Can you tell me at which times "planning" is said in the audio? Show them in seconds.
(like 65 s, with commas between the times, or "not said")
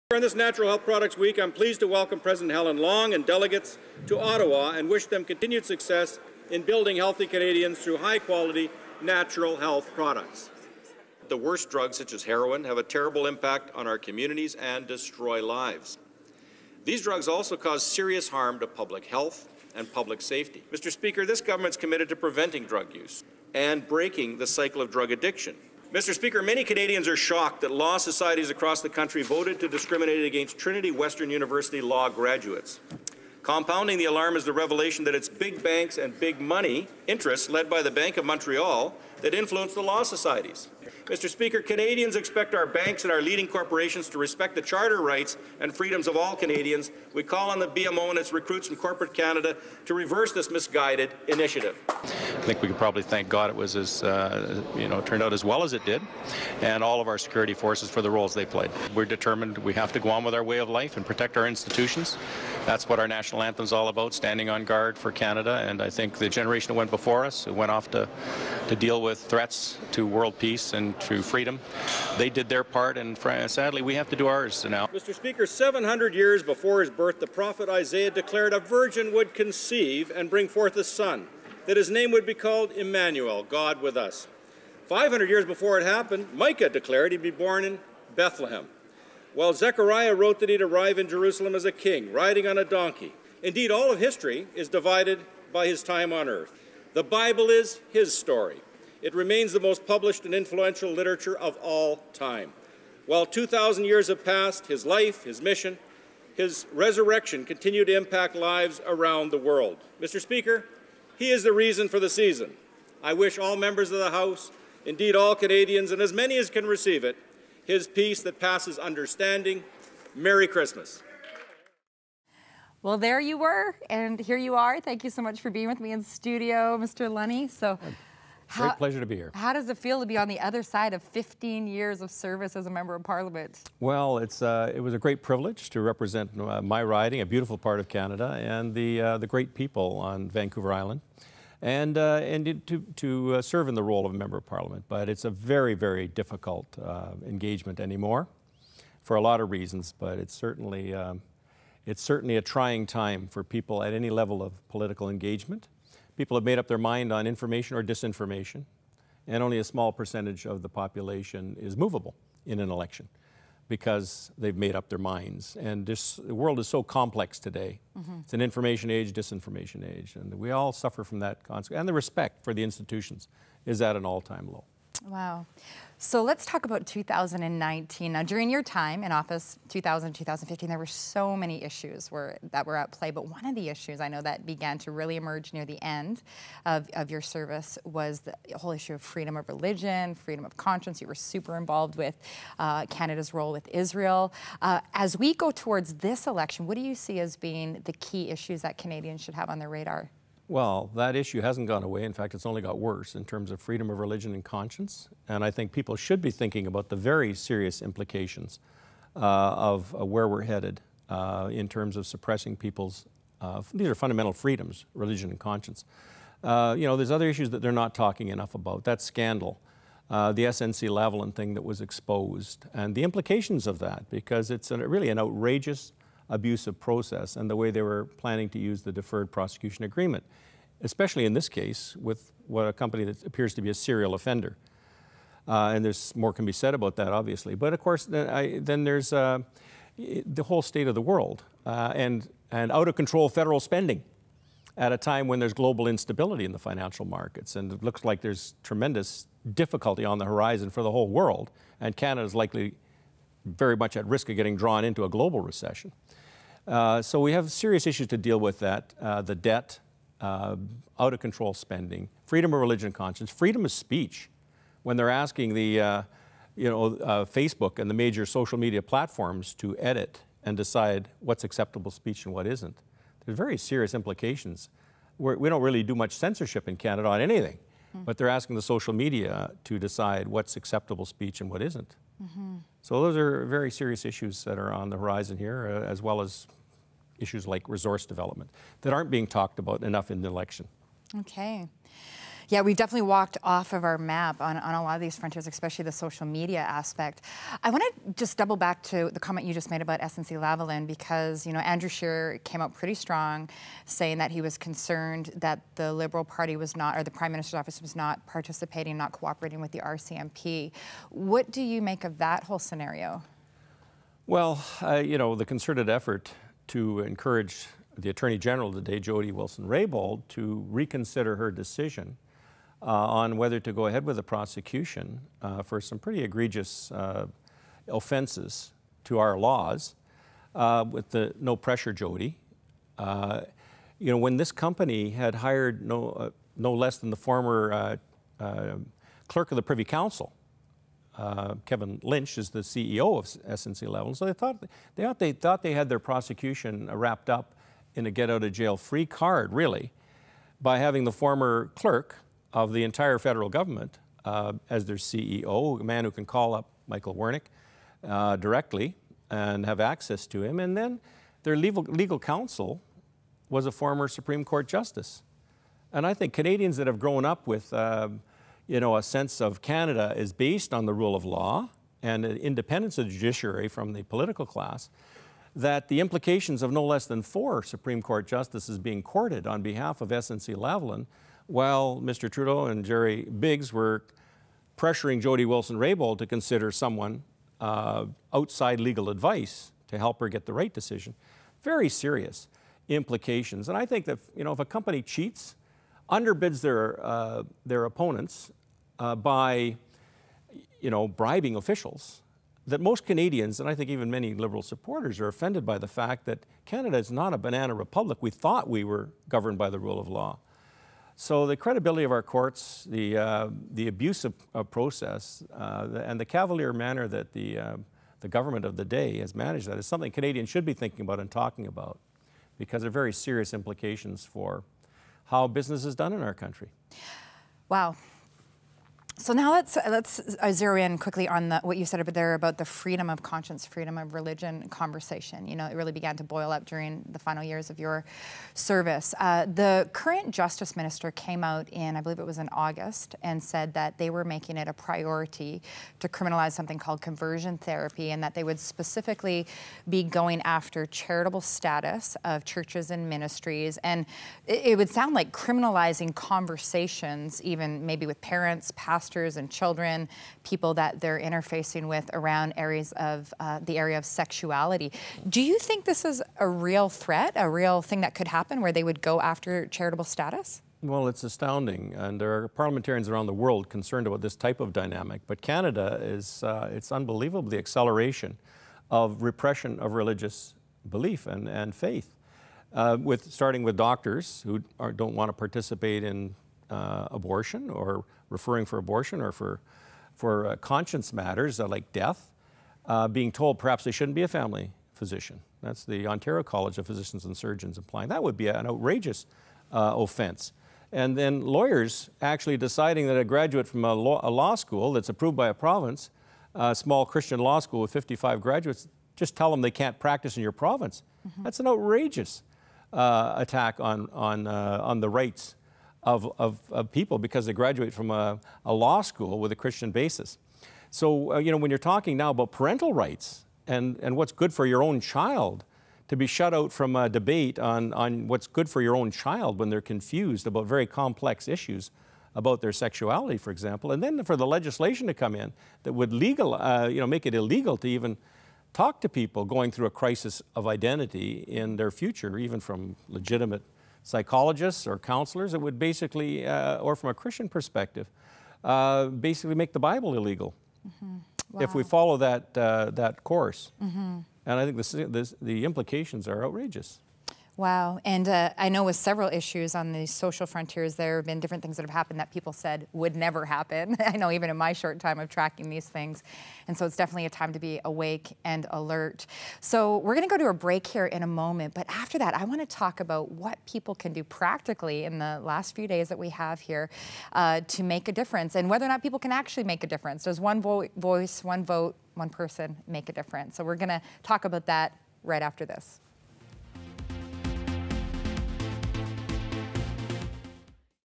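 228 s.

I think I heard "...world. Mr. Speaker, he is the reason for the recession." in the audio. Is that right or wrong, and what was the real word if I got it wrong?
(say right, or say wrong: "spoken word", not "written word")
wrong: "season", not "recession".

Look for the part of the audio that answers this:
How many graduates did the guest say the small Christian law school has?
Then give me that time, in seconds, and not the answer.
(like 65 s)
507 s.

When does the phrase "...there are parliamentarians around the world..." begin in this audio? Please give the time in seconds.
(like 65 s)
472 s.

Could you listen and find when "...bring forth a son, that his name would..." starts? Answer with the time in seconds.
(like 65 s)
80 s.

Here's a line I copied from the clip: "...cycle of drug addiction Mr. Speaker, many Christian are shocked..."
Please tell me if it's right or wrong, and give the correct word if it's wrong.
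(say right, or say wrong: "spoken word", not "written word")
wrong: "Canadians", not "Christian".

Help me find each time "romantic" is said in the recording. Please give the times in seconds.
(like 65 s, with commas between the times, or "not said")
not said.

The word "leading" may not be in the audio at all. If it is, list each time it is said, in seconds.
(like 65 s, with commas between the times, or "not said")
43 s.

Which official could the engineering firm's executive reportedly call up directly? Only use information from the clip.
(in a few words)
Michael Wernick.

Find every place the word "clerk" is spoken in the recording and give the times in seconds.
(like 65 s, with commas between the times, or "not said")
339 s, 351 s.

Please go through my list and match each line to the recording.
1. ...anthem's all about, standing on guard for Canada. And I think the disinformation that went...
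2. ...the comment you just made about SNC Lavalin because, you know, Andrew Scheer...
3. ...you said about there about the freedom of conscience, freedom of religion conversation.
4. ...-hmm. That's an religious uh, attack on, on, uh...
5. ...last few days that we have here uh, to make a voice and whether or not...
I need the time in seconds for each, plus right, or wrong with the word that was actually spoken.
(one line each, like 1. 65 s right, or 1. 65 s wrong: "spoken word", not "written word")
1. 63 s wrong: "generation", not "disinformation"
2. 299 s right
3. 431 s right
4. 511 s wrong: "outrageous", not "religious"
5. 575 s wrong: "difference", not "voice".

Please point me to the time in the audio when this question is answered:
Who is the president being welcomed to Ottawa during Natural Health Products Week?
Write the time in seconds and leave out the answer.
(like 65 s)
2 s.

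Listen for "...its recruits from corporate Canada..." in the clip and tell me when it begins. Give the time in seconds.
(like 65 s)
48 s.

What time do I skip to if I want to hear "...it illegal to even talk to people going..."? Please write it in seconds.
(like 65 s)
537 s.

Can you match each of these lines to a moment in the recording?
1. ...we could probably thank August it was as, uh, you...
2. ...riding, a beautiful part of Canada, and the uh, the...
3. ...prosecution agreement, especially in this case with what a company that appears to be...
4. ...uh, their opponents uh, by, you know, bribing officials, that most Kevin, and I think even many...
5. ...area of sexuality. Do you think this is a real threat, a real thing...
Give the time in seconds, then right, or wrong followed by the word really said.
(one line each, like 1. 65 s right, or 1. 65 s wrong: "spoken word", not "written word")
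1. 52 s wrong: "God", not "August"
2. 136 s right
3. 229 s right
4. 397 s wrong: "Canadians", not "Kevin"
5. 463 s right.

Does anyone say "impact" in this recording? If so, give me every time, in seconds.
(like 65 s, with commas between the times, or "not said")
13 s, 107 s.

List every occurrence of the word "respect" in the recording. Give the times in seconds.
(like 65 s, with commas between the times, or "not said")
44 s, 172 s.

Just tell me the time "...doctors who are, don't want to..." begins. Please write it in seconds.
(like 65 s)
483 s.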